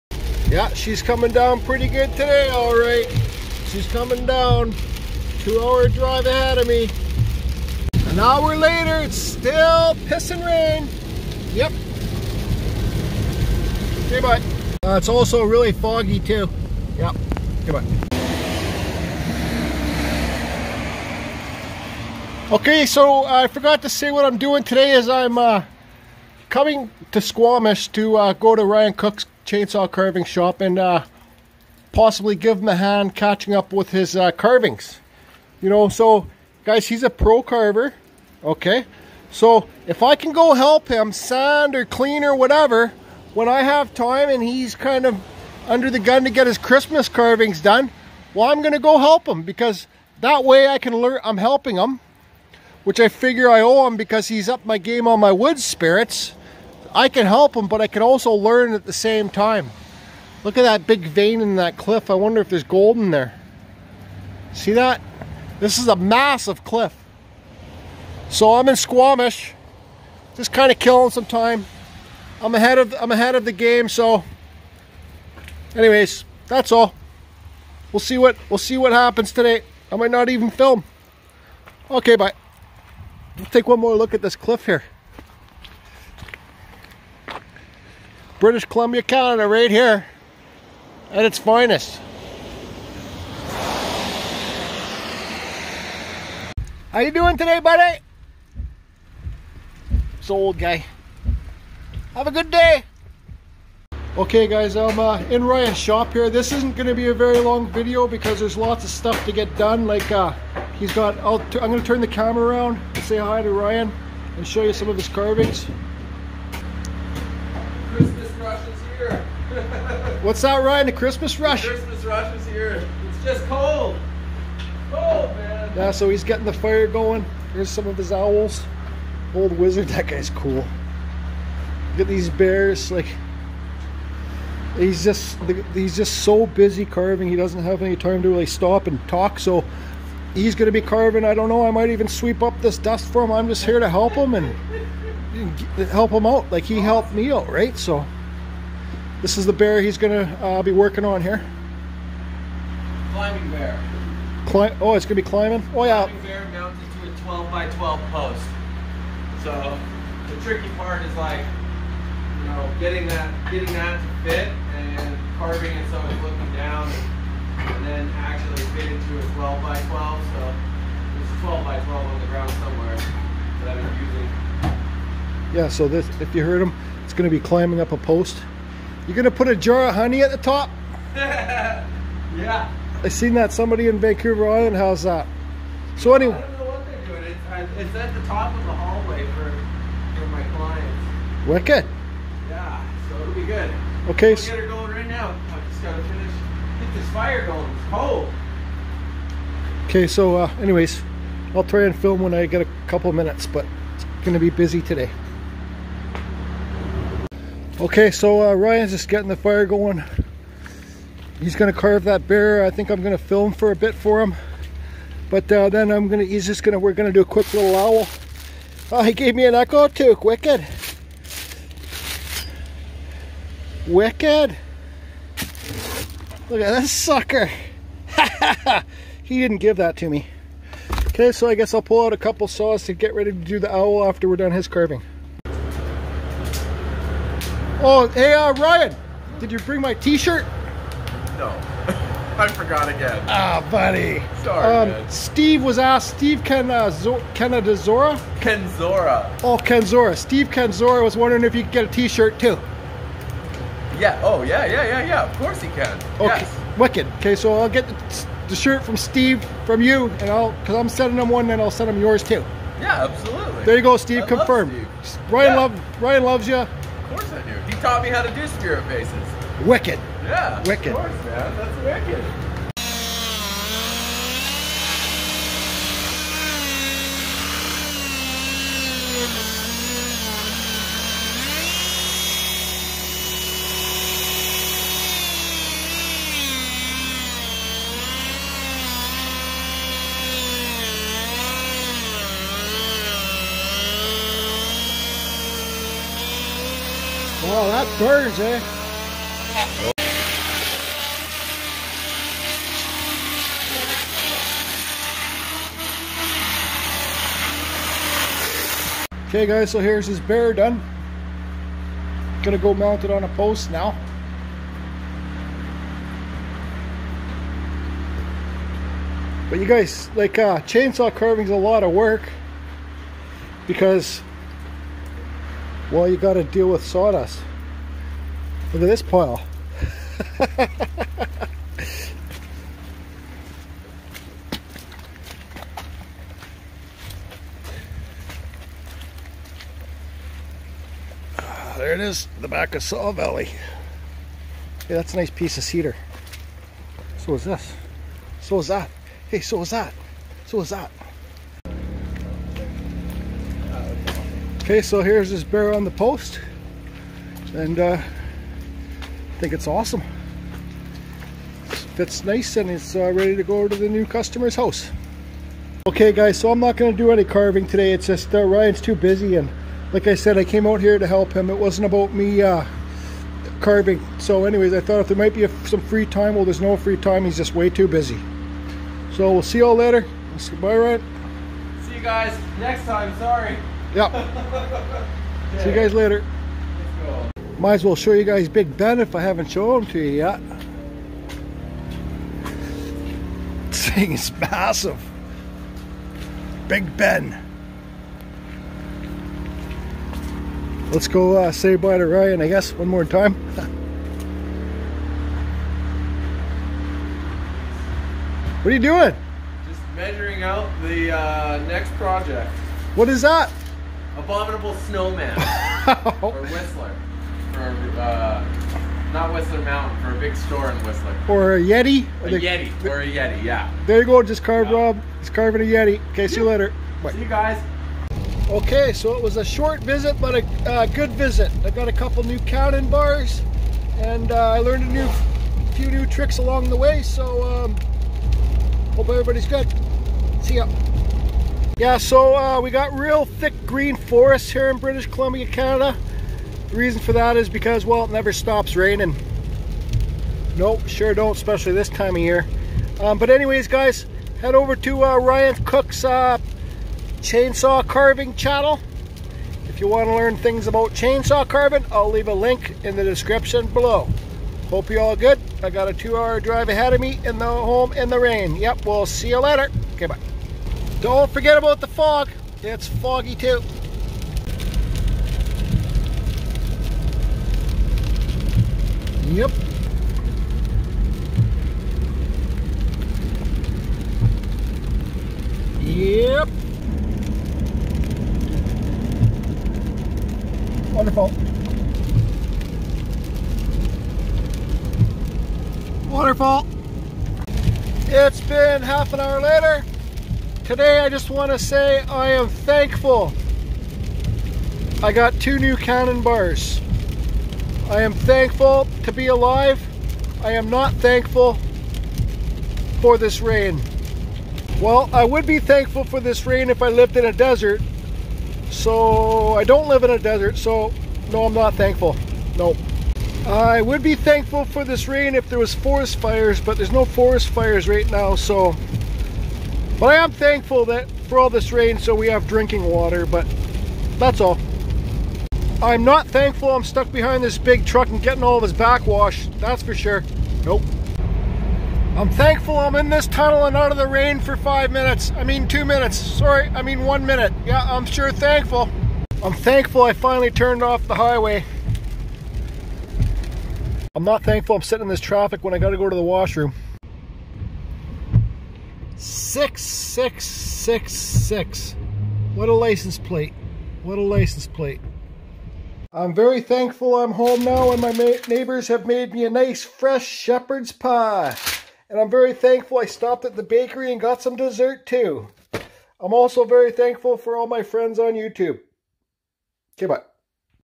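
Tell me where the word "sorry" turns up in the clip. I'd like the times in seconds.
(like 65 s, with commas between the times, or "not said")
244 s, 383 s, 546 s.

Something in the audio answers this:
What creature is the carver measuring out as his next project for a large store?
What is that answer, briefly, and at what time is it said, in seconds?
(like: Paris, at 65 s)
Abominable Snowman, at 414 s.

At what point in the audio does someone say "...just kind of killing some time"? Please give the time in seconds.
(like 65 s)
70 s.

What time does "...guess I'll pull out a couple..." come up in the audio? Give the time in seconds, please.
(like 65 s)
231 s.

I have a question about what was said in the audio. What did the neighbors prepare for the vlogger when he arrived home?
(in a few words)
Shepherd's pie.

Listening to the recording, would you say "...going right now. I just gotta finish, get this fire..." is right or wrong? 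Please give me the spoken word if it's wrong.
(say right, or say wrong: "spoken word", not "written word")
right.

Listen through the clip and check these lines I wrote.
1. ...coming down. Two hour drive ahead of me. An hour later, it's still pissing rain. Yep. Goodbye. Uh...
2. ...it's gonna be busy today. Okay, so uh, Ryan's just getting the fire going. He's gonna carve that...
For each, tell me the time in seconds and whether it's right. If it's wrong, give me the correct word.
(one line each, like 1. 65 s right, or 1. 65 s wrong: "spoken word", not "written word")
1. 3 s right
2. 203 s right.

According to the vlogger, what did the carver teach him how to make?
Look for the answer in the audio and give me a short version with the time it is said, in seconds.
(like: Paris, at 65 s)
Spirit faces, at 268 s.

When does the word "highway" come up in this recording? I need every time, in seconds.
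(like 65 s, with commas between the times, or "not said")
551 s.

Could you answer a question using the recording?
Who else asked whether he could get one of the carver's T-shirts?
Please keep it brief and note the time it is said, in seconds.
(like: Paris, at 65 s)
Steve Kenzora, at 250 s.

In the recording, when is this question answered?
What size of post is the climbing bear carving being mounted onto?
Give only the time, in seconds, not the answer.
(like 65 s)
157 s.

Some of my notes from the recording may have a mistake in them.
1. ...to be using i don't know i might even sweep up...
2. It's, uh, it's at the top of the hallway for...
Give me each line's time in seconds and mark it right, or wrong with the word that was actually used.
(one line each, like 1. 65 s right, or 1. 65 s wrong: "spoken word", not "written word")
1. 140 s wrong: "carving", not "using"
2. 187 s right.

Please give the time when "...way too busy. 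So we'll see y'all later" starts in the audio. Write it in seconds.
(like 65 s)
377 s.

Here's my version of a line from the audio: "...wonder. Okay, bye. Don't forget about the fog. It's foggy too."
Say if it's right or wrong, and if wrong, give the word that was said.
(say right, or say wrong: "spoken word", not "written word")
wrong: "later", not "wonder".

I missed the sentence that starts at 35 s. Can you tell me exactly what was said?
You know, so guys, he's a pro carver, okay?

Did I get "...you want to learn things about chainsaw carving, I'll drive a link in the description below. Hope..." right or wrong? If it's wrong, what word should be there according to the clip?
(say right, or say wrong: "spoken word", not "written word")
wrong: "leave", not "drive".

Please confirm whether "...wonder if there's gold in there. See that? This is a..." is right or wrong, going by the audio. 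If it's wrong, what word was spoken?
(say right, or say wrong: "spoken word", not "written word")
right.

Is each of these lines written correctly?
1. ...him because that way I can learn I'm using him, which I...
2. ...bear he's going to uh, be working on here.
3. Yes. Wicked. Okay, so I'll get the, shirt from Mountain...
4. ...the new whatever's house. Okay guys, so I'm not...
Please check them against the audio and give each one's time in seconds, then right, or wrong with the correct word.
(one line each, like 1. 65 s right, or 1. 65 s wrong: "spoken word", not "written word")
1. 49 s wrong: "helping", not "using"
2. 149 s right
3. 256 s wrong: "Steve", not "Mountain"
4. 363 s wrong: "customer", not "whatever".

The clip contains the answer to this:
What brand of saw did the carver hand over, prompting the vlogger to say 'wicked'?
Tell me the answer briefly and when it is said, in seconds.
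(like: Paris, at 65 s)
Echo, at 219 s.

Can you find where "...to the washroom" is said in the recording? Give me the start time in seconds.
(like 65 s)
556 s.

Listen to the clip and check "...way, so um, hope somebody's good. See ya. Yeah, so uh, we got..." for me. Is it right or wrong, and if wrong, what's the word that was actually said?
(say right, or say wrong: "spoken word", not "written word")
wrong: "everybody", not "somebody".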